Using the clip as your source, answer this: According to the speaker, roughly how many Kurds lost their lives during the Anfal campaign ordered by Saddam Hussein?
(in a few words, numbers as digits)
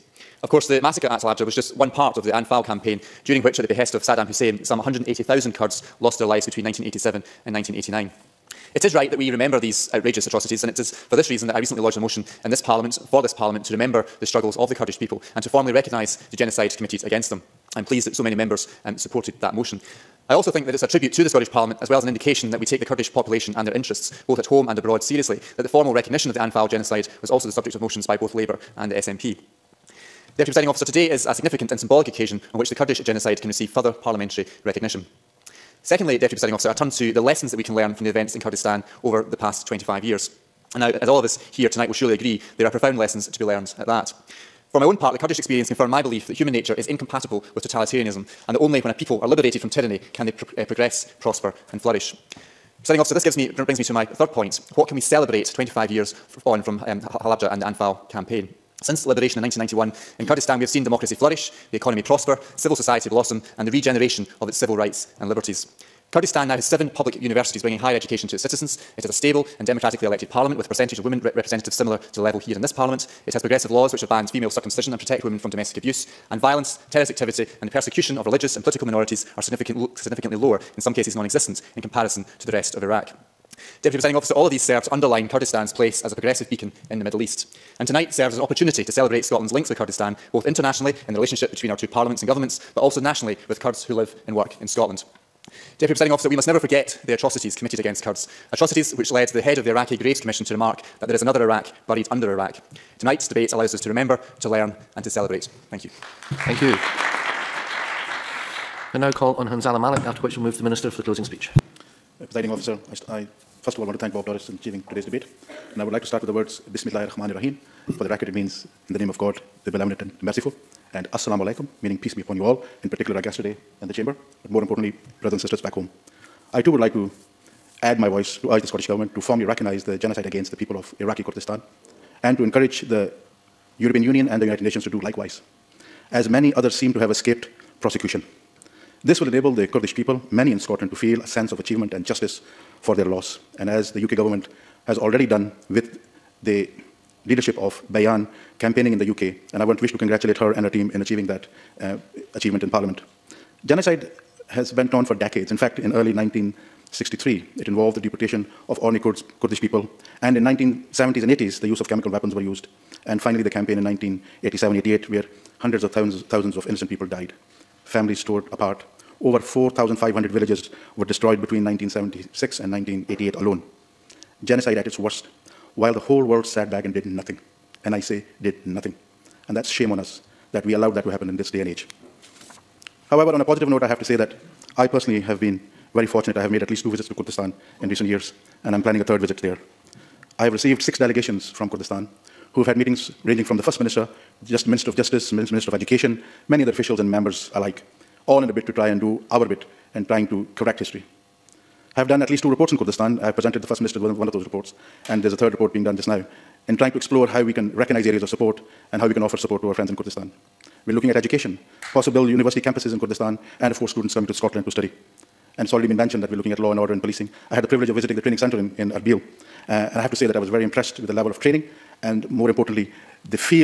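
180,000.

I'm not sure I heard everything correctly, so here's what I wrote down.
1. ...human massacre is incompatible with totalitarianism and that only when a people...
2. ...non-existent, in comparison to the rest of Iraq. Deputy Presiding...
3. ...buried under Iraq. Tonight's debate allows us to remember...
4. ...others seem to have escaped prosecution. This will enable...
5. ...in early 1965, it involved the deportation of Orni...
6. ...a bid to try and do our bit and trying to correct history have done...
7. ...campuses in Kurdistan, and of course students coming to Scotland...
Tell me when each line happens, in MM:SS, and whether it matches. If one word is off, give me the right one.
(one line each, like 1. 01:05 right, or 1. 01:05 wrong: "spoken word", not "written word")
1. 00:46 wrong: "nature", not "massacre"
2. 01:21 right
3. 01:41 right
4. 02:16 right
5. 02:35 wrong: "1963", not "1965"
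6. 03:18 right
7. 03:32 right.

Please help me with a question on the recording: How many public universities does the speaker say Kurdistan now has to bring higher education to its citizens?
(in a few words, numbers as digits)
7.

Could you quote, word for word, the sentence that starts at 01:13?
It has progressive laws which have banned female circumcision and protect women from domestic abuse.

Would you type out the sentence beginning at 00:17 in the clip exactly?
I'm pleased that so many members um, supported that motion.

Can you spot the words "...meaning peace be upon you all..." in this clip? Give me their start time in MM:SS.
02:01.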